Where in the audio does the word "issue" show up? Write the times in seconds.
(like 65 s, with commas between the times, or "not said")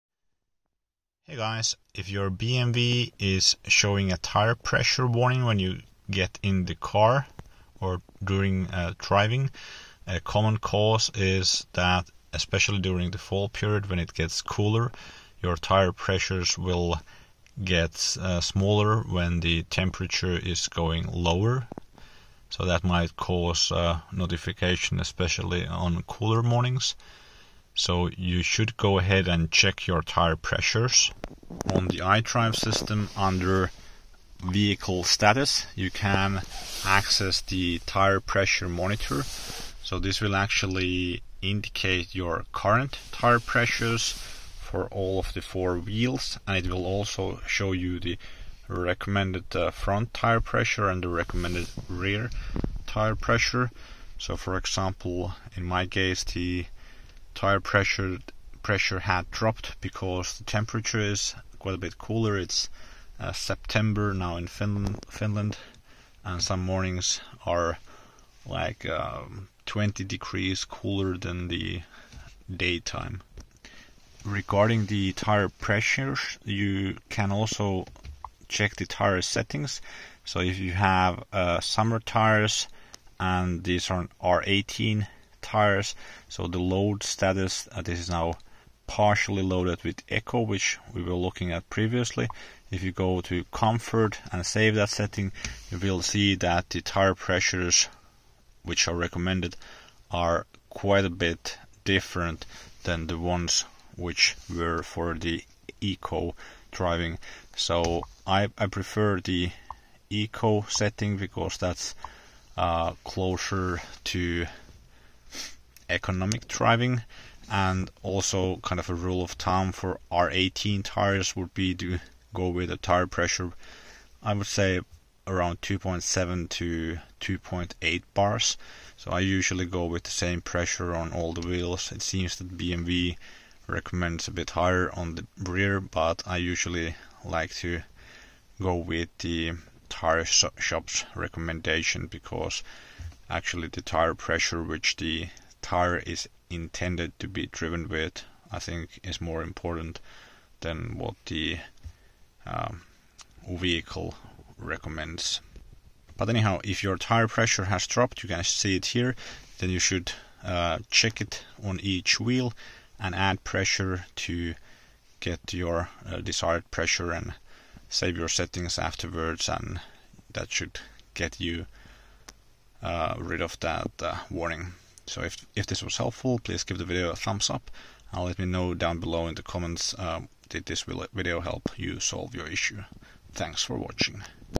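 182 s.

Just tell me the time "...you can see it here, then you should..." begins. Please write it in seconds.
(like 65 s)
158 s.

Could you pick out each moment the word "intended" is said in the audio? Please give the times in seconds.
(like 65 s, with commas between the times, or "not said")
146 s.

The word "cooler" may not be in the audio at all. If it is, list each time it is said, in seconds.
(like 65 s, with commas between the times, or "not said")
14 s, 26 s, 61 s, 70 s.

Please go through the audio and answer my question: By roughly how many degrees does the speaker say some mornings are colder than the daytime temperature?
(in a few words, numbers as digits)
20 degrees.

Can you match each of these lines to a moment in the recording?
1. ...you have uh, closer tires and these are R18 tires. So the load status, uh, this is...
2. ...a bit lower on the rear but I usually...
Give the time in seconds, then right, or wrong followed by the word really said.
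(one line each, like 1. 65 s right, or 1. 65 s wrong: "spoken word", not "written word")
1. 80 s wrong: "summer", not "closer"
2. 134 s wrong: "higher", not "lower".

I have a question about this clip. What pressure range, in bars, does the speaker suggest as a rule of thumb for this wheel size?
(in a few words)
2.7 to 2.8 bars.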